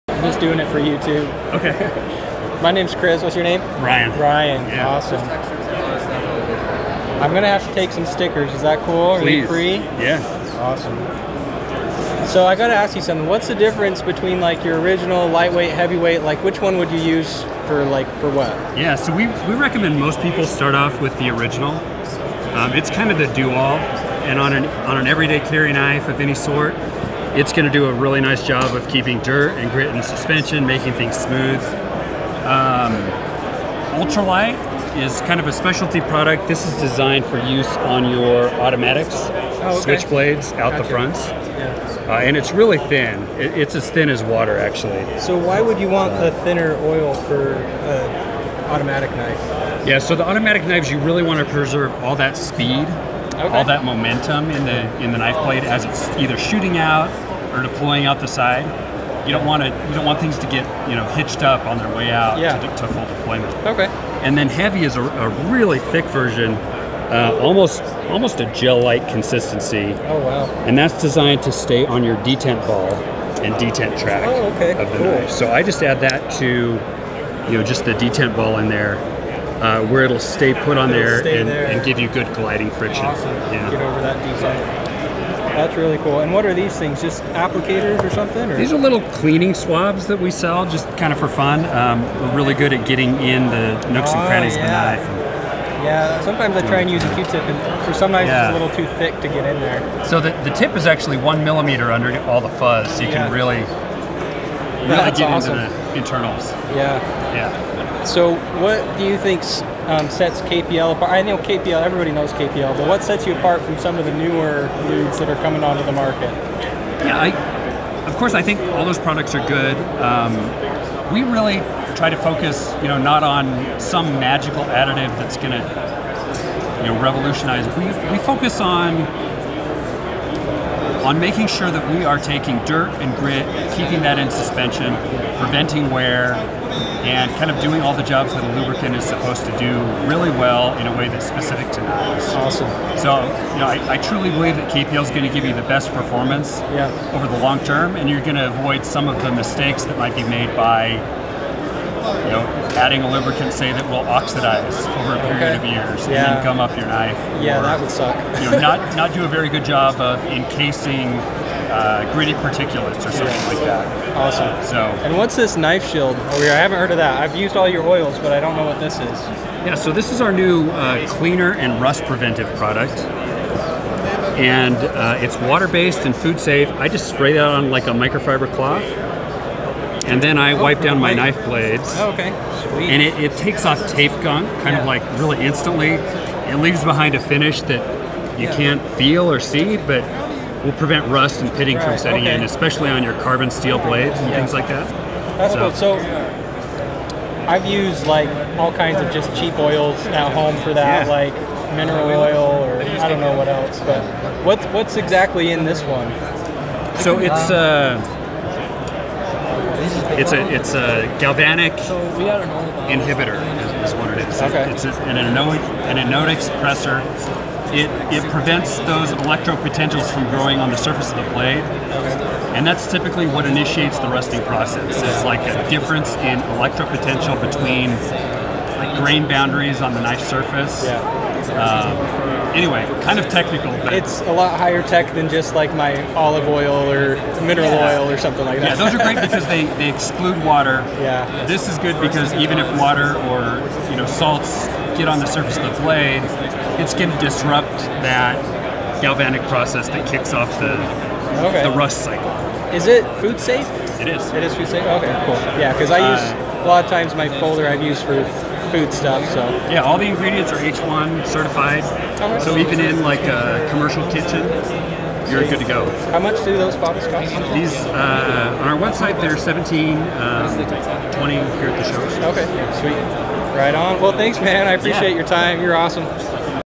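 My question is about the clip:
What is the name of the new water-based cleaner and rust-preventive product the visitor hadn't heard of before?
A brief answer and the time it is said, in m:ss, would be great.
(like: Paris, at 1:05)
Knife Shield, at 2:45.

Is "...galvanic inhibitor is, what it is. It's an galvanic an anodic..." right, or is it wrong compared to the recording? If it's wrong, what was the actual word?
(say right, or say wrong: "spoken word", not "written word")
wrong: "anodic", not "galvanic".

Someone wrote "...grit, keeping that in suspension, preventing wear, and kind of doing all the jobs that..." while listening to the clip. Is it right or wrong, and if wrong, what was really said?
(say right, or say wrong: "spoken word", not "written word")
right.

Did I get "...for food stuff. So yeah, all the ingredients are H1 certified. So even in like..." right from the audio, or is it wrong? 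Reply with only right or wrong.
right.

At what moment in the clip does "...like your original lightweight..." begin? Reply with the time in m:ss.
0:14.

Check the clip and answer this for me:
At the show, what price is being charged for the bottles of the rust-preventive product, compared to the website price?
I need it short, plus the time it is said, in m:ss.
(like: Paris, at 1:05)
$20, at 4:30.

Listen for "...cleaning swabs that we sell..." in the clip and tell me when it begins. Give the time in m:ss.
1:29.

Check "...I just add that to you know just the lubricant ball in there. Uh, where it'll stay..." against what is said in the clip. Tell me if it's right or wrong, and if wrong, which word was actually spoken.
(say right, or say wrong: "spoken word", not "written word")
wrong: "detent", not "lubricant".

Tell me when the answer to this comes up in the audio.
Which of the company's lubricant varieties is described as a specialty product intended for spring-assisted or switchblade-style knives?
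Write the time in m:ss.
0:34.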